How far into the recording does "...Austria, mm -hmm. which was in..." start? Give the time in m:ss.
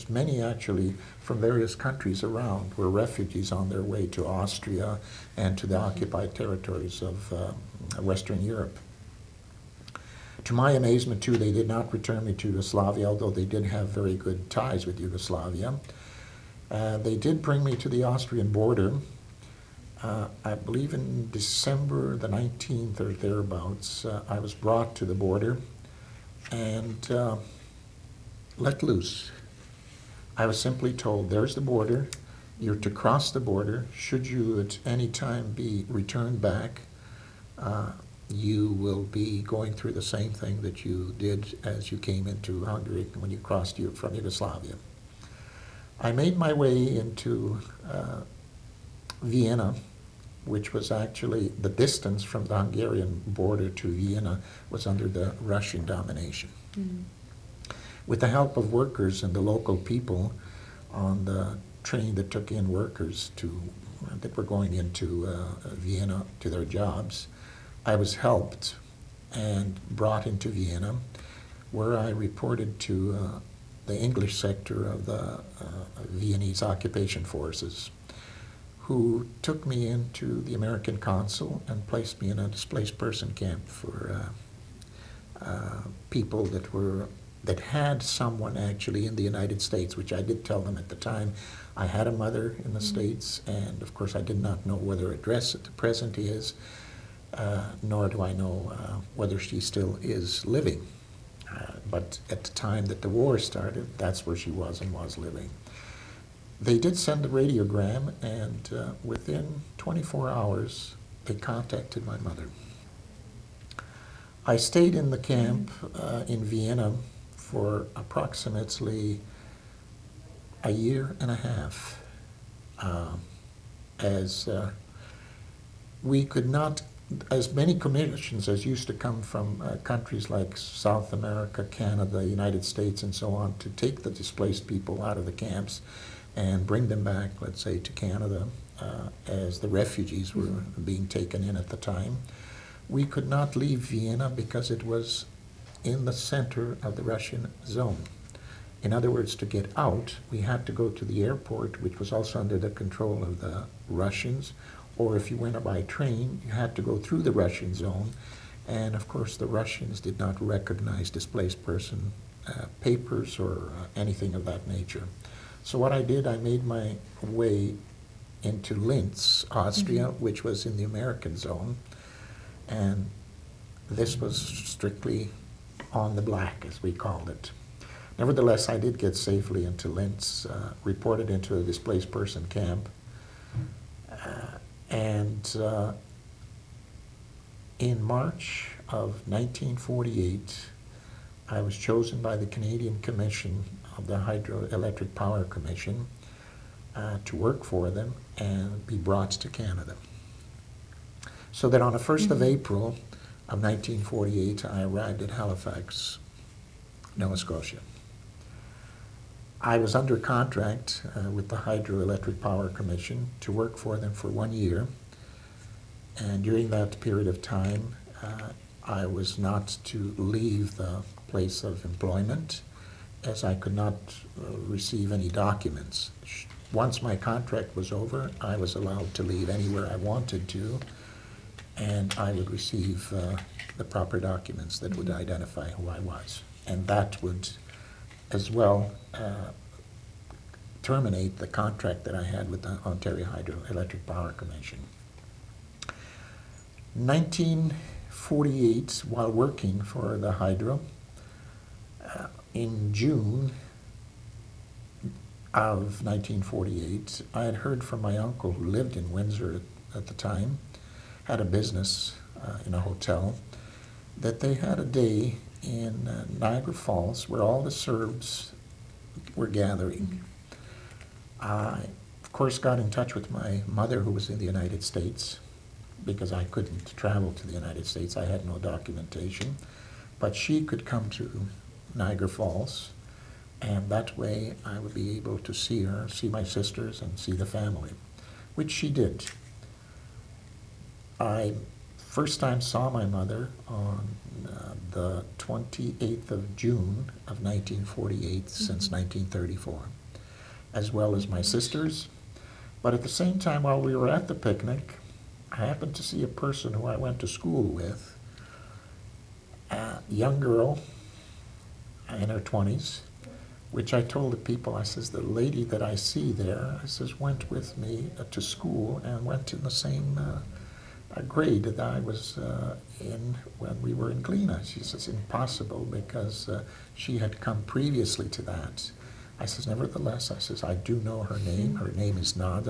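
2:49.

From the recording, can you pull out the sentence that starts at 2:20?
being taken in at the time.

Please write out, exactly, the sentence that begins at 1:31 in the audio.
I had a mother in the mm -hmm.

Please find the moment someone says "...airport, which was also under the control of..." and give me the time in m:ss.
2:31.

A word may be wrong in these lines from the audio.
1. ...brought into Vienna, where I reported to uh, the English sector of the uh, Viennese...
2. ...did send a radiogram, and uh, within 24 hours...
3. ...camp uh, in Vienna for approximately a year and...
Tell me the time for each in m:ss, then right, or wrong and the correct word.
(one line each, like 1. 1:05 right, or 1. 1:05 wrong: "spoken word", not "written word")
1. 1:09 right
2. 1:46 right
3. 1:55 right.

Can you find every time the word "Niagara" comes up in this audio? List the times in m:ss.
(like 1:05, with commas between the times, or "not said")
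4:26, 4:41.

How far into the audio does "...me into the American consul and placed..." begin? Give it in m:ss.
1:19.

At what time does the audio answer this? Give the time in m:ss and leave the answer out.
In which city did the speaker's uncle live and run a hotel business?
4:19.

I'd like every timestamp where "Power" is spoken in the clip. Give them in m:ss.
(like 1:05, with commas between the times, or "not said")
3:15, 3:32, 4:04.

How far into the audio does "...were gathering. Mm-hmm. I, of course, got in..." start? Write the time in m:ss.
4:29.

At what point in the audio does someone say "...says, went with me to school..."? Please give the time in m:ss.
5:16.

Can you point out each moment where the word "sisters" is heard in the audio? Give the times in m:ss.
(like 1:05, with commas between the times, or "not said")
4:46, 5:01.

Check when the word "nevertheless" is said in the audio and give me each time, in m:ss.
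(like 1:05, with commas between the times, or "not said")
2:58, 5:29.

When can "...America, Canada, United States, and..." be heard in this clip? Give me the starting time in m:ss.
2:11.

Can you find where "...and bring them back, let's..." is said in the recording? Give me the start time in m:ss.
2:16.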